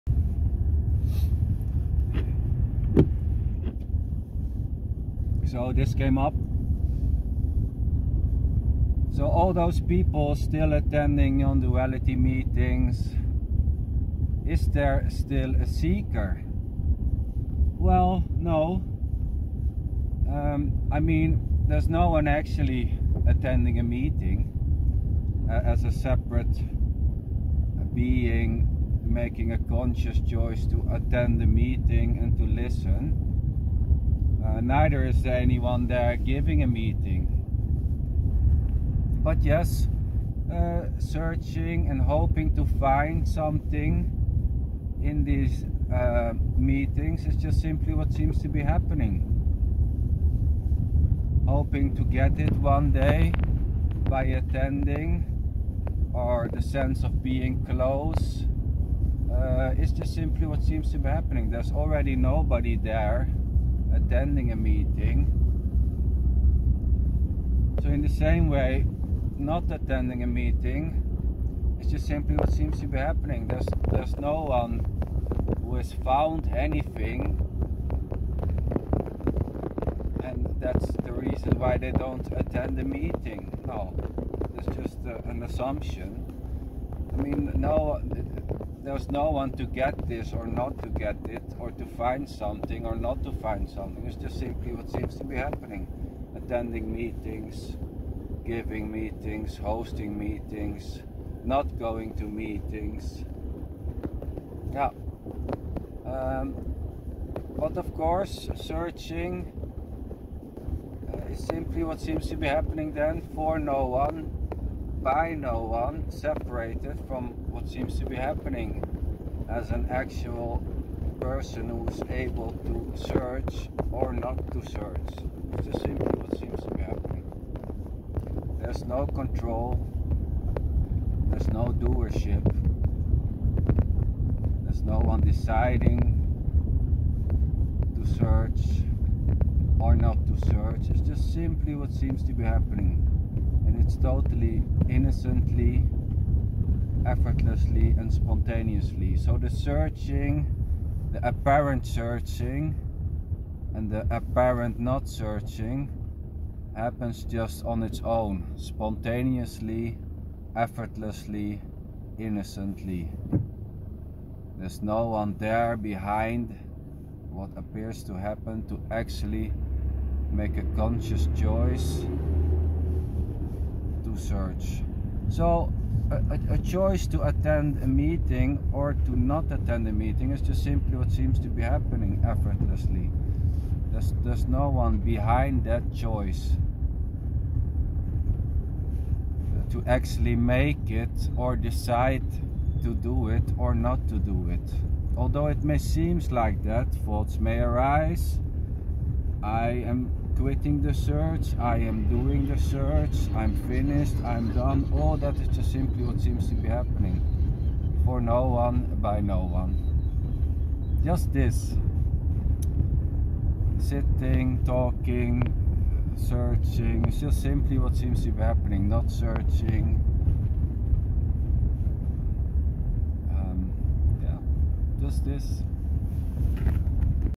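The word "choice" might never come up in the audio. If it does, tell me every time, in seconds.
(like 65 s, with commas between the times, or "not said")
30 s, 171 s, 176 s, 185 s.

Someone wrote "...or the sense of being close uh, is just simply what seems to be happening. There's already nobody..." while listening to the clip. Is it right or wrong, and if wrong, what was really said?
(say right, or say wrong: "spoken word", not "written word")
right.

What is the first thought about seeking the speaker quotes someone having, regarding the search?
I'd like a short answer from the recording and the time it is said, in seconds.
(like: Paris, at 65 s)
quitting the search, at 200 s.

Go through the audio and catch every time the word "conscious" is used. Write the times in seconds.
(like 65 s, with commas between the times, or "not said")
29 s, 170 s.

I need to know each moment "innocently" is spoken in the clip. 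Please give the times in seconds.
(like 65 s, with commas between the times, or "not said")
144 s, 162 s.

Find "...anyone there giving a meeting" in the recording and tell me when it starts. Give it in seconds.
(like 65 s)
35 s.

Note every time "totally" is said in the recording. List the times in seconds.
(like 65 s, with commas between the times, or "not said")
143 s.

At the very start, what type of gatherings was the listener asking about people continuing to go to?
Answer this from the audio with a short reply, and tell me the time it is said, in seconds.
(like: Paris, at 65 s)
nonduality meetings, at 11 s.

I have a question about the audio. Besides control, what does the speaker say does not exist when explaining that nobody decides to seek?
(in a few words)
doership.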